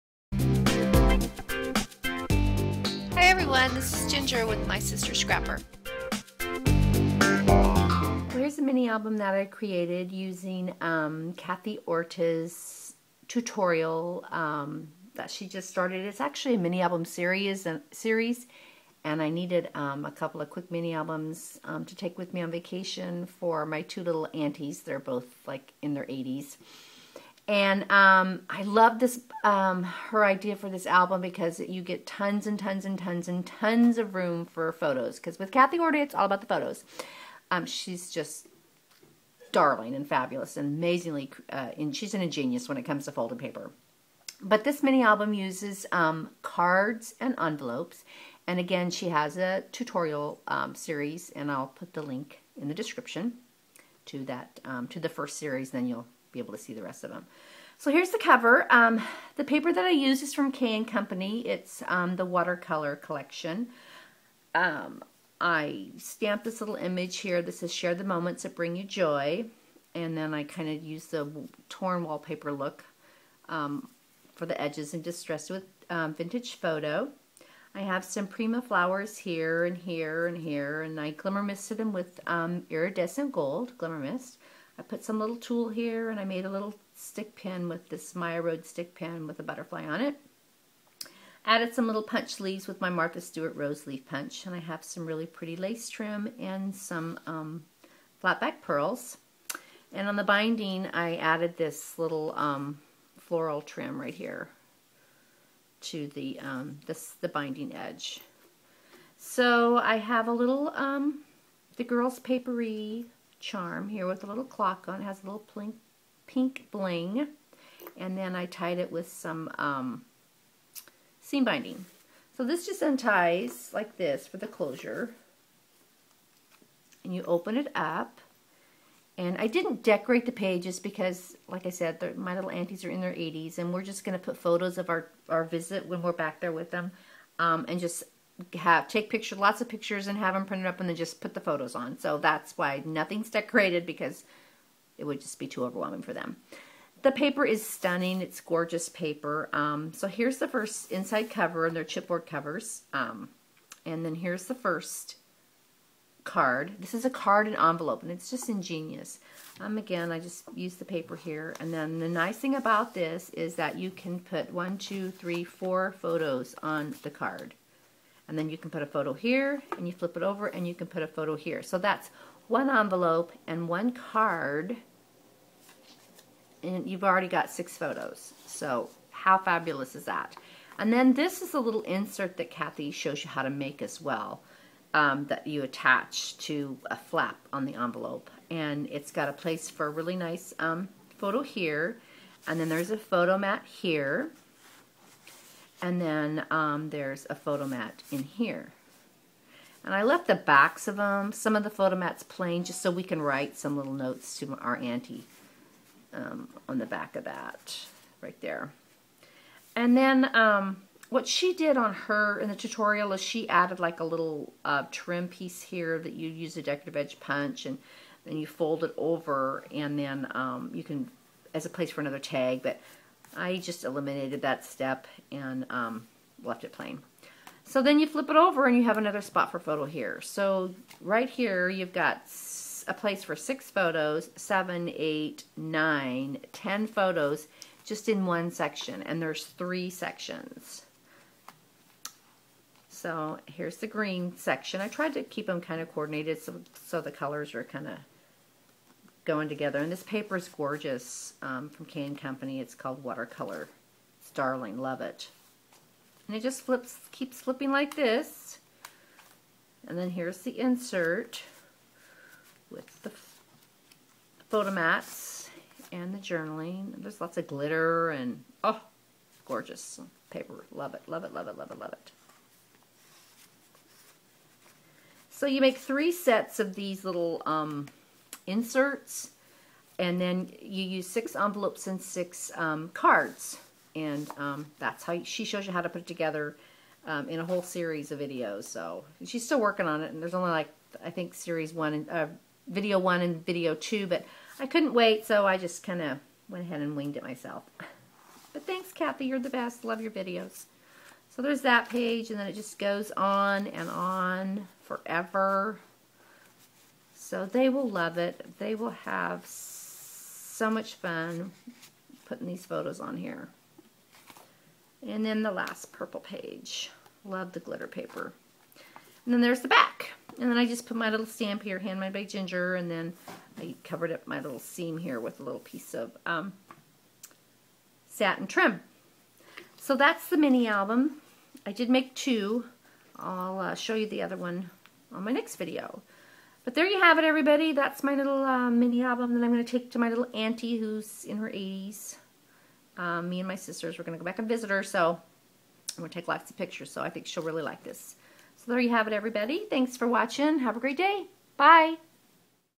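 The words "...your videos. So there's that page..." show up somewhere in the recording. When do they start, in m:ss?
5:00.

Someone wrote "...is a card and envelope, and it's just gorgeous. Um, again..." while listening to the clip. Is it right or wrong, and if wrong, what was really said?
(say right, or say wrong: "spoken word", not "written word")
wrong: "ingenious", not "gorgeous".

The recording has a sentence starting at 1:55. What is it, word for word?
It has a little pink pink bling.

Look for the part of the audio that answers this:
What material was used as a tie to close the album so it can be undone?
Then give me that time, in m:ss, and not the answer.
2:01.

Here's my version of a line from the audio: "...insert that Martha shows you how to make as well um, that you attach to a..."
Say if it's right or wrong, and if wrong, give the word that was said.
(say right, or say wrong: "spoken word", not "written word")
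wrong: "Kathy", not "Martha".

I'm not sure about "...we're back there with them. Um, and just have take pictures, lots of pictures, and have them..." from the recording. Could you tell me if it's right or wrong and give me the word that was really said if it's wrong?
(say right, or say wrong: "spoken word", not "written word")
right.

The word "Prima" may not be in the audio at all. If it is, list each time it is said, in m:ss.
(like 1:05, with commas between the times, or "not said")
1:18.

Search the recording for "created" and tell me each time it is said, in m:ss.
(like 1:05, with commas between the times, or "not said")
0:09.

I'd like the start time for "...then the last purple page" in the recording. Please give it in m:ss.
5:15.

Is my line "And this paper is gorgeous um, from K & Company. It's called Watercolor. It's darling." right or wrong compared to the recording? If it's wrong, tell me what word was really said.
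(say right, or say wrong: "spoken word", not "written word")
right.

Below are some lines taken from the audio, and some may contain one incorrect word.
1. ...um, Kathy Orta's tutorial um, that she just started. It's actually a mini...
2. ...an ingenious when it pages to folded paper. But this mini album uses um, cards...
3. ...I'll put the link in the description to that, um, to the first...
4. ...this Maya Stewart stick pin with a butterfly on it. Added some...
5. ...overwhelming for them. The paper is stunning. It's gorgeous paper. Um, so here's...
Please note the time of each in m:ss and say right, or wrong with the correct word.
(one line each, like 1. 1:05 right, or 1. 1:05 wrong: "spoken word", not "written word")
1. 0:10 right
2. 0:42 wrong: "comes", not "pages"
3. 0:51 right
4. 1:27 wrong: "Road", not "Stewart"
5. 2:25 right.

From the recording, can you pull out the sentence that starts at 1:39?
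And on the binding, I added this little um, floral trim right here to the, um, this, the binding edge.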